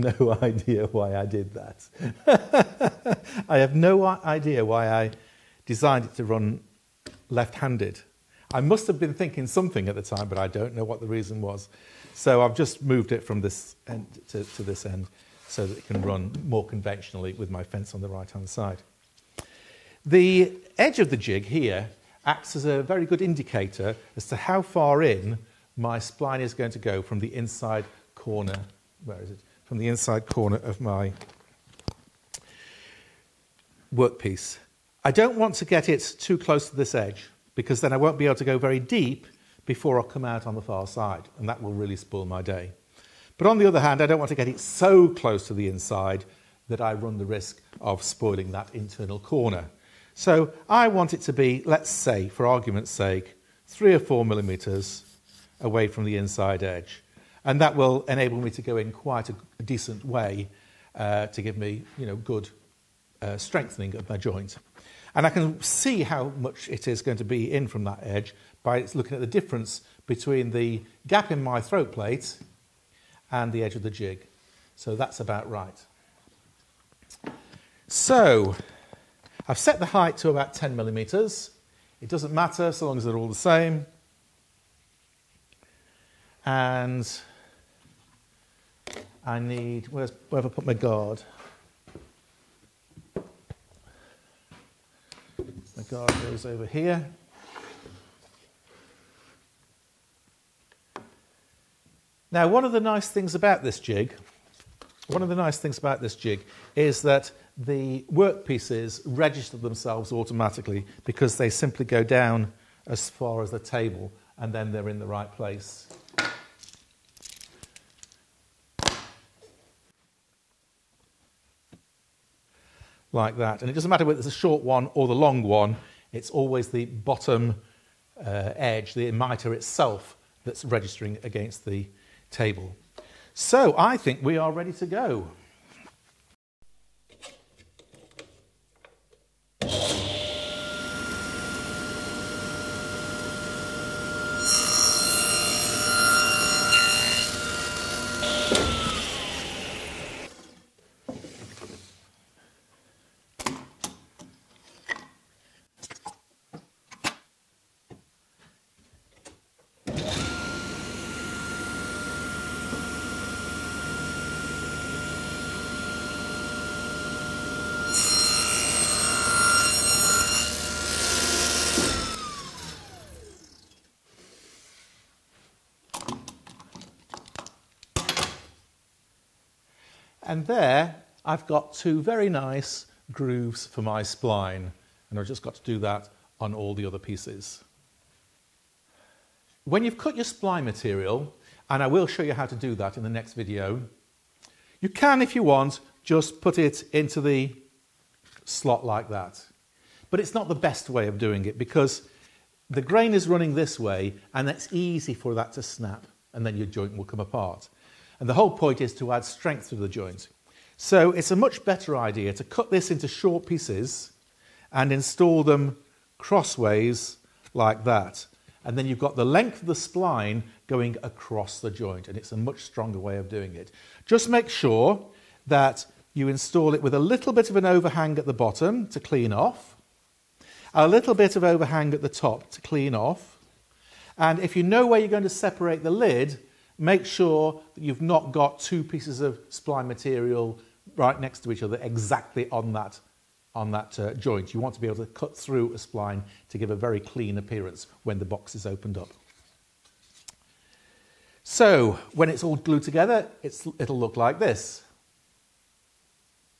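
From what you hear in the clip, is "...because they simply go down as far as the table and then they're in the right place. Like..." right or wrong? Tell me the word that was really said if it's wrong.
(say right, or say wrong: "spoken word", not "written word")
right.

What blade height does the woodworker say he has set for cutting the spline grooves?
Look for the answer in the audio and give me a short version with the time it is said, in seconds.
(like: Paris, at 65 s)
10 millimeters, at 80 s.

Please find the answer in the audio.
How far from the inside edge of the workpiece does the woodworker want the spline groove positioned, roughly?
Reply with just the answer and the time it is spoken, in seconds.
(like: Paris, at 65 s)
3 or 4 millimetres, at 53 s.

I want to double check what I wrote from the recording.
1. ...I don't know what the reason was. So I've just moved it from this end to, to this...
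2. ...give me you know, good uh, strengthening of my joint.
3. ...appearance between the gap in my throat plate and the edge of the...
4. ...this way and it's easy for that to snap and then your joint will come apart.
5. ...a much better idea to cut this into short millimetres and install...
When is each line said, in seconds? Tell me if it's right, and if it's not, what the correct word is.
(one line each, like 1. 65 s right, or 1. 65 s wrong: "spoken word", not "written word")
1. 10 s right
2. 61 s right
3. 69 s wrong: "difference", not "appearance"
4. 203 s right
5. 211 s wrong: "pieces", not "millimetres".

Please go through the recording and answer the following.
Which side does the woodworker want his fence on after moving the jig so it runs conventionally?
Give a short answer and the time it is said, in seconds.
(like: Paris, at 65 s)
Right hand side, at 18 s.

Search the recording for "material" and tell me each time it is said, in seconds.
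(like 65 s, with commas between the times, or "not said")
190 s, 239 s.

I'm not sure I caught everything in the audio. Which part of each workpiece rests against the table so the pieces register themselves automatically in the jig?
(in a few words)
The mitre.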